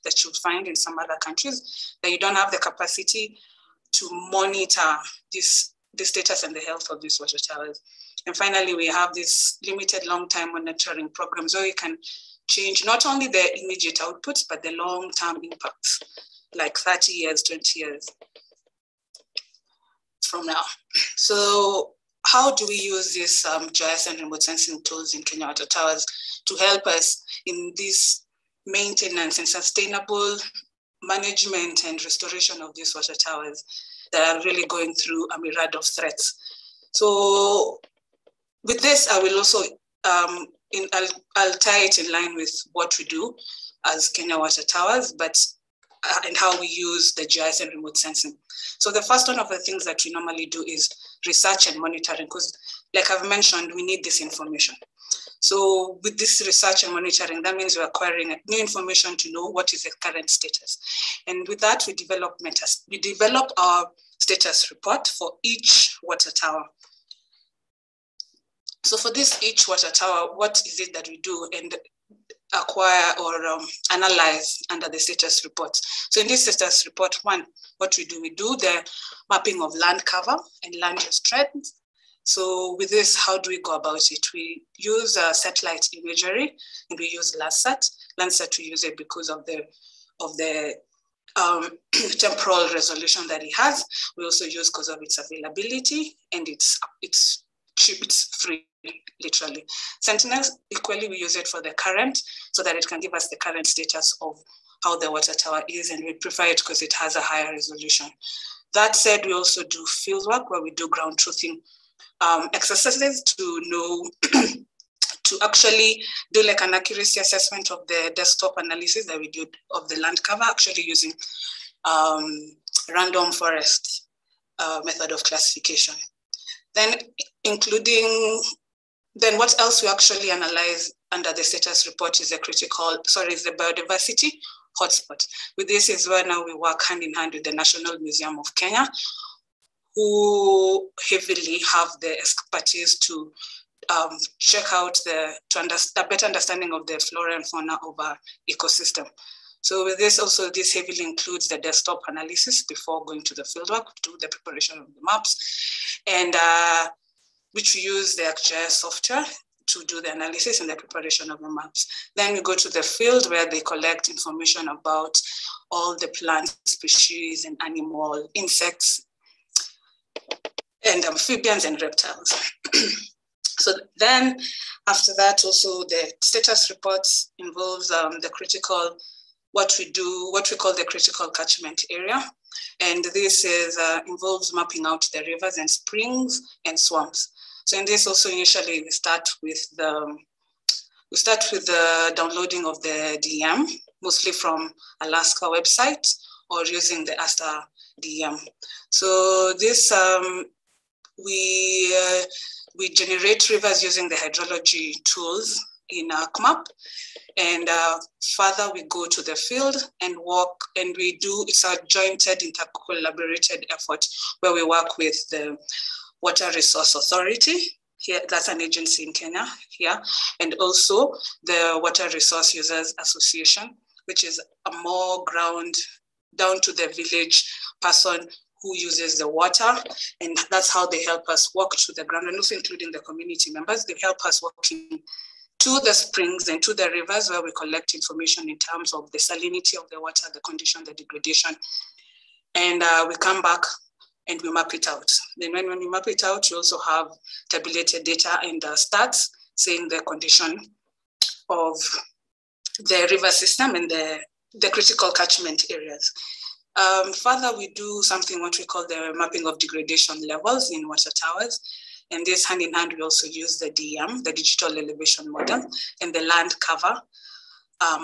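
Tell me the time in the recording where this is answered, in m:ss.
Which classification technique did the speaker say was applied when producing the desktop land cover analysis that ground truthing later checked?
2:02.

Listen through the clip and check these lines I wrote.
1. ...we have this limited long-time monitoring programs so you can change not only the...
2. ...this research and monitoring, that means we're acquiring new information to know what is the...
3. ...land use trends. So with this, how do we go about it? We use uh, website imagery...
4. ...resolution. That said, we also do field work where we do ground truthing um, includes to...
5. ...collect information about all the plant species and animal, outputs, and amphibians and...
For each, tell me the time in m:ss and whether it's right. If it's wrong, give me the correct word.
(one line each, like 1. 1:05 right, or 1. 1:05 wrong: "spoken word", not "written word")
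1. 0:08 right
2. 0:56 right
3. 1:20 wrong: "satellite", not "website"
4. 1:47 wrong: "exercises", not "includes"
5. 2:43 wrong: "insects", not "outputs".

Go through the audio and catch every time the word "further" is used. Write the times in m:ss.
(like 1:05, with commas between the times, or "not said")
3:28, 4:17.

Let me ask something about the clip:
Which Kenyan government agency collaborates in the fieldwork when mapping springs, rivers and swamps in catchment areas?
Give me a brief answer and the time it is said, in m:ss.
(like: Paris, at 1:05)
Water Resource Authority, at 3:36.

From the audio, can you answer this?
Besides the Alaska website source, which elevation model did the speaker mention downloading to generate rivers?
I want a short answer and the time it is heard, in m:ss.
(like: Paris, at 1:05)
ASTER DEM, at 3:17.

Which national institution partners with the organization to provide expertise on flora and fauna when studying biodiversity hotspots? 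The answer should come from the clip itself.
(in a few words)
National Museum of Kenya.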